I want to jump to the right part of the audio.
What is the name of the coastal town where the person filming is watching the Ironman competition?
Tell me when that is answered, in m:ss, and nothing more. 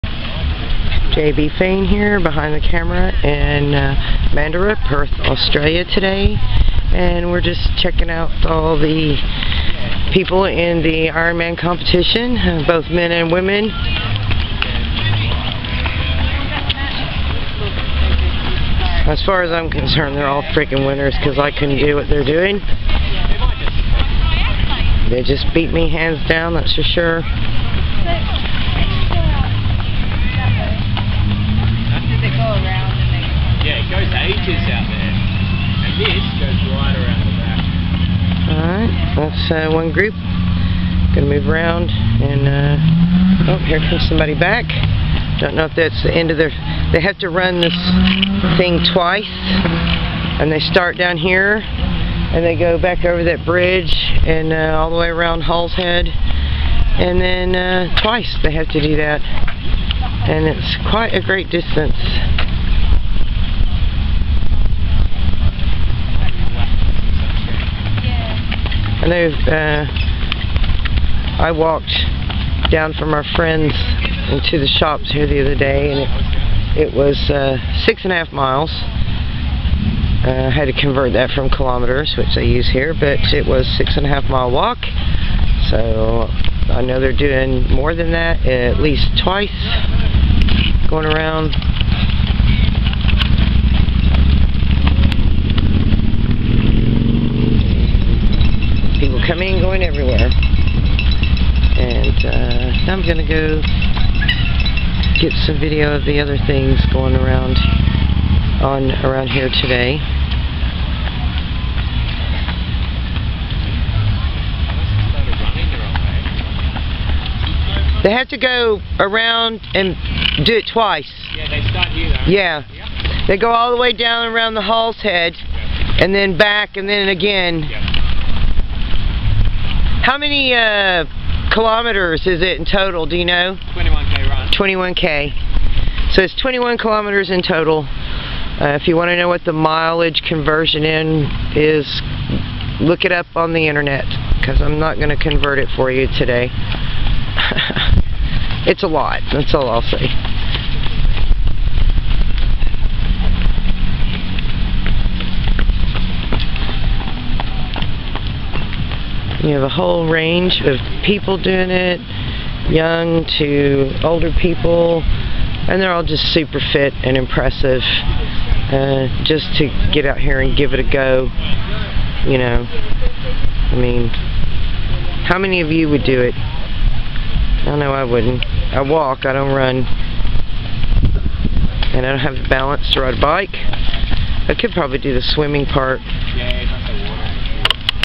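0:04.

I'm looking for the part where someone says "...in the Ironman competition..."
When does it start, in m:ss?
0:10.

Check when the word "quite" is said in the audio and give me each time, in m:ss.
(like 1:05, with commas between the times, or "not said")
1:00.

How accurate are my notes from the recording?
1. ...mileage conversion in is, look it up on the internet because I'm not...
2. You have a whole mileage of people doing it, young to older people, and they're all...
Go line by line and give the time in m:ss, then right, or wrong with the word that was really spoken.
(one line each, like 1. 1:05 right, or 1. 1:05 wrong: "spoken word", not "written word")
1. 2:19 right
2. 2:39 wrong: "range", not "mileage".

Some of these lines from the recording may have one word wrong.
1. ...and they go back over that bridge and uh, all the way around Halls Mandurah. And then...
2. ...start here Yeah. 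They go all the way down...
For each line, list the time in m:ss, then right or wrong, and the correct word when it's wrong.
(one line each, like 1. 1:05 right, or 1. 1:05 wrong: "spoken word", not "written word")
1. 0:51 wrong: "Head", not "Mandurah"
2. 2:01 right.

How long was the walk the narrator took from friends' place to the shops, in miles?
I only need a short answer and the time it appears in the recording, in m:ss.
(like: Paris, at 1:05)
6.5 miles, at 1:17.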